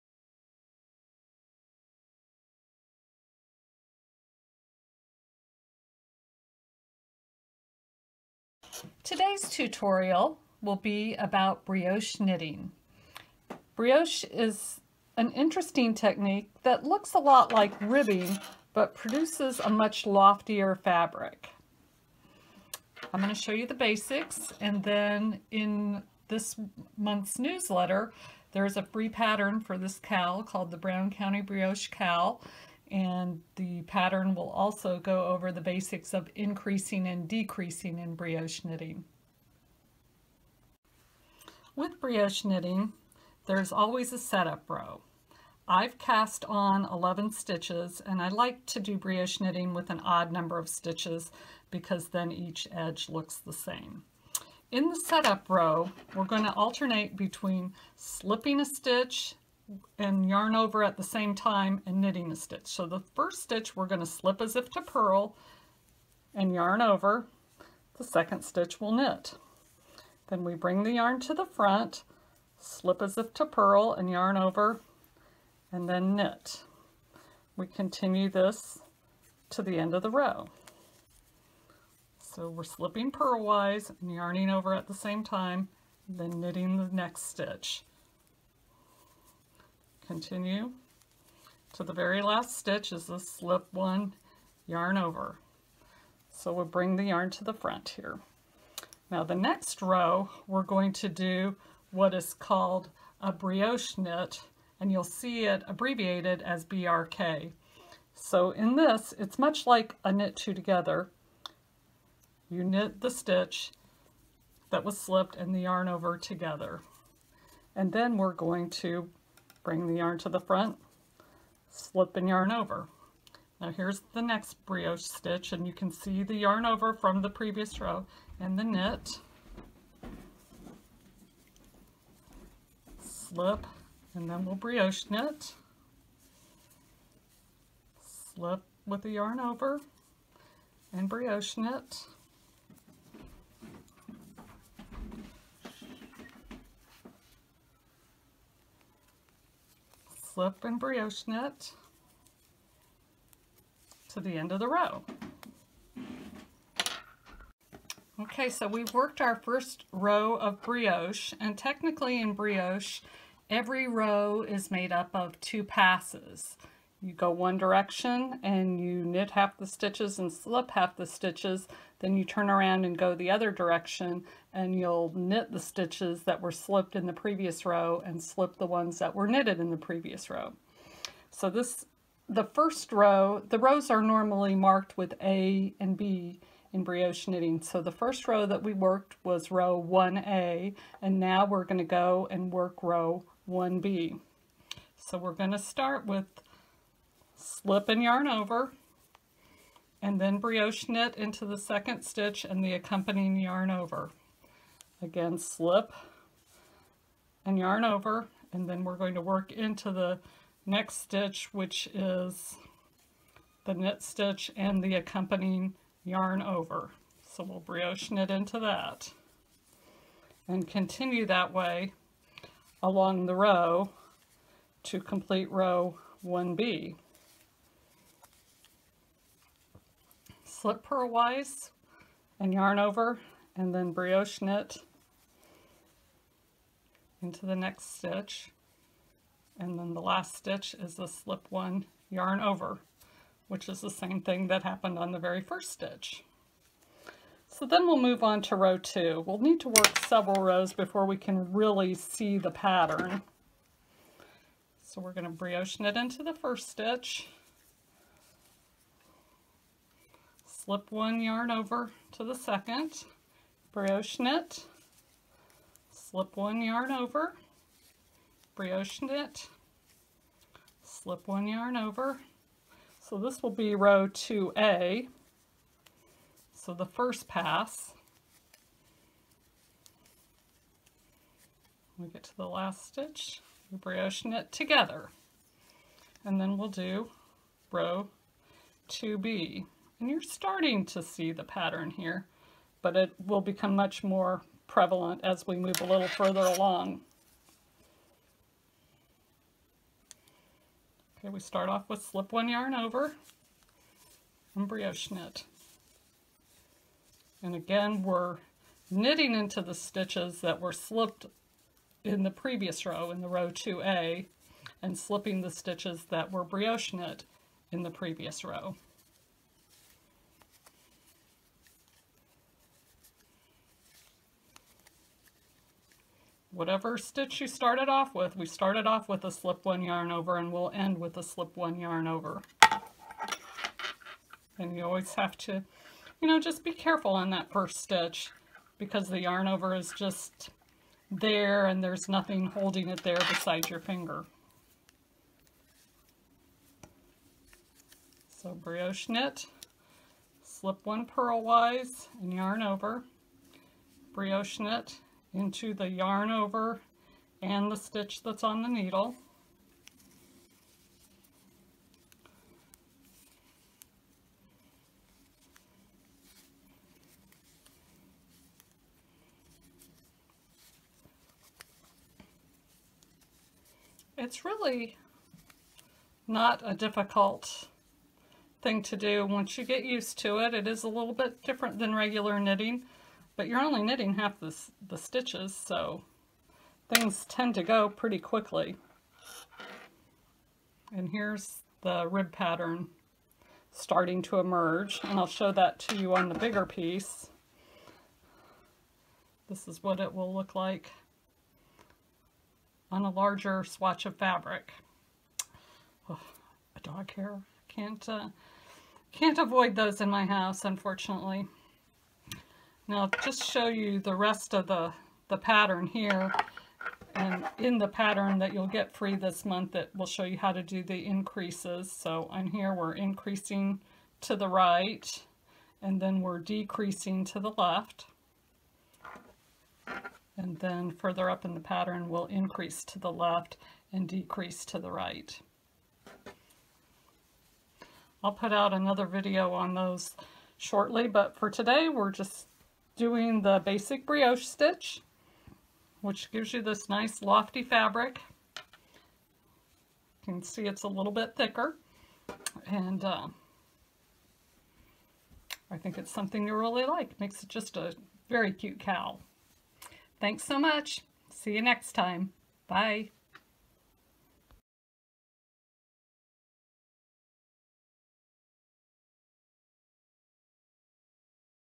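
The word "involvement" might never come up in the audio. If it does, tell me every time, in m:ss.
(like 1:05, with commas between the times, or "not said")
not said.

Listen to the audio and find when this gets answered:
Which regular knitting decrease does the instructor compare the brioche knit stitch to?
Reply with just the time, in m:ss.
1:50.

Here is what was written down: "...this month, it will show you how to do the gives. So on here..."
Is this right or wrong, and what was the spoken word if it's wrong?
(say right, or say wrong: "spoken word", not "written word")
wrong: "increases", not "gives".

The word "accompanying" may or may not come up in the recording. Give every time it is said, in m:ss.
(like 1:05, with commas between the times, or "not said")
3:22, 3:34.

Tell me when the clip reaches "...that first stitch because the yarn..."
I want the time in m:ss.
5:37.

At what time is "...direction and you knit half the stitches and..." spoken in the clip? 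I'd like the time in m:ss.
2:47.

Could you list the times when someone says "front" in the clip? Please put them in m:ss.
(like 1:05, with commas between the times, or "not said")
1:11, 1:37, 2:00.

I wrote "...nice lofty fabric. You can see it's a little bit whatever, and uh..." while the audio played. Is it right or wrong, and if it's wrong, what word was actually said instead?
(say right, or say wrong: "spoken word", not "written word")
wrong: "thicker", not "whatever".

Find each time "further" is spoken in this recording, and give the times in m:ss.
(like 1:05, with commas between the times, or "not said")
4:56, 7:10.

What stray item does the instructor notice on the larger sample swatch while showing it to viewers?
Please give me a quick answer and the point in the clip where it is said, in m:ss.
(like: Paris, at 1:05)
A dog hair, at 6:46.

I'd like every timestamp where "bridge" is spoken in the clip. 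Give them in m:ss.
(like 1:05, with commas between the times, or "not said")
not said.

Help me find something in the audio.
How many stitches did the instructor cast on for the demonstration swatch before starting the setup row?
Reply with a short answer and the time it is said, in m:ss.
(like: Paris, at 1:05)
11, at 0:46.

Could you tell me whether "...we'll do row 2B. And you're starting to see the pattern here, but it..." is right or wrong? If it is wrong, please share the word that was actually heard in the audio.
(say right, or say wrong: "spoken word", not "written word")
right.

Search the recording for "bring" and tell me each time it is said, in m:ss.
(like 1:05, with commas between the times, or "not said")
1:10, 1:36, 1:59.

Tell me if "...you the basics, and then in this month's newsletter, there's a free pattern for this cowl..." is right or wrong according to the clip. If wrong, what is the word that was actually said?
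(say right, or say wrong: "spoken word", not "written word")
right.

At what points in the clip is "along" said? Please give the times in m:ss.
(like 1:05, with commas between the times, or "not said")
3:42, 4:56.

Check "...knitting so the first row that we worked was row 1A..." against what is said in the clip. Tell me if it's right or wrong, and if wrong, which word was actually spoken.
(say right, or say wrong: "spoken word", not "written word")
right.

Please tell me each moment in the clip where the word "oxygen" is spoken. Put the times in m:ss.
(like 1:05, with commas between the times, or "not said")
not said.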